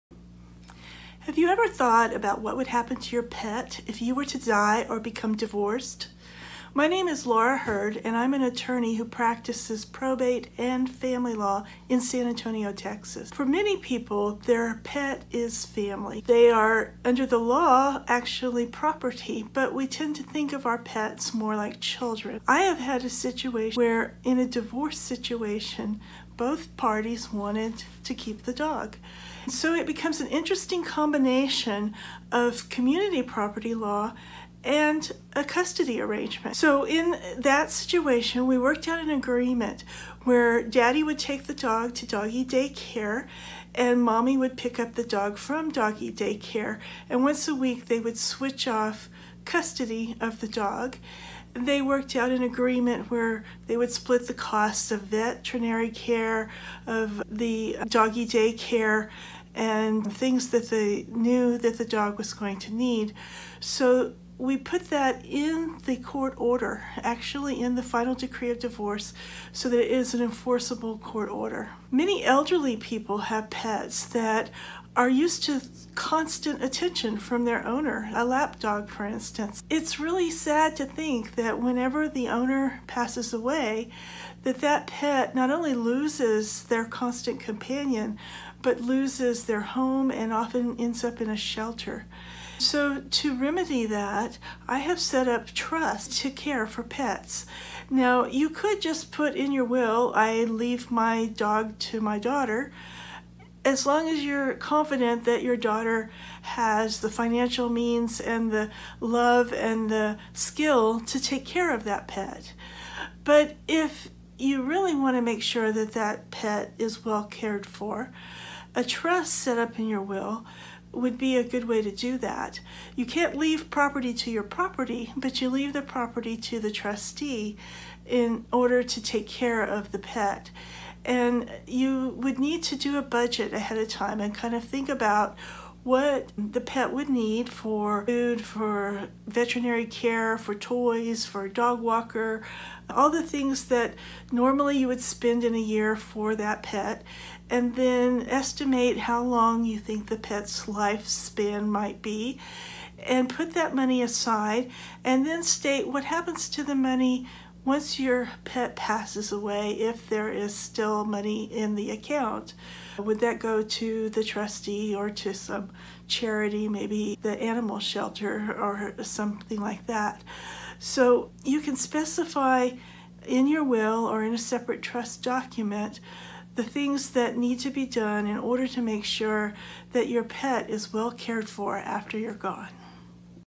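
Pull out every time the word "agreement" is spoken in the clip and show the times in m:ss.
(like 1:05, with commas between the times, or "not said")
0:39, 0:52.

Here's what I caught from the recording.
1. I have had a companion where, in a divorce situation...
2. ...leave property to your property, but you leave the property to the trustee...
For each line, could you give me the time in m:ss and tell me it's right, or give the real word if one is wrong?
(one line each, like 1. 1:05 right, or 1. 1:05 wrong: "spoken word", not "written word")
1. 0:22 wrong: "situation", not "companion"
2. 2:03 right.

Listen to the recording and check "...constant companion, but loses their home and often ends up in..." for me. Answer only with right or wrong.
right.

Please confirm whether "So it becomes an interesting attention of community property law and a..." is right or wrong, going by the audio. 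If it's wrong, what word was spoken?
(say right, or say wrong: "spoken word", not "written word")
wrong: "combination", not "attention".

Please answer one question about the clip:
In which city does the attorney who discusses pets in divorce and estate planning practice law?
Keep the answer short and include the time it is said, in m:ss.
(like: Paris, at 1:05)
San Antonio, Texas, at 0:12.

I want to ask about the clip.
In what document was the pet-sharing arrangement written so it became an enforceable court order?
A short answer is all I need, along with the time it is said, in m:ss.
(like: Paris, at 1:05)
final decree of divorce, at 1:07.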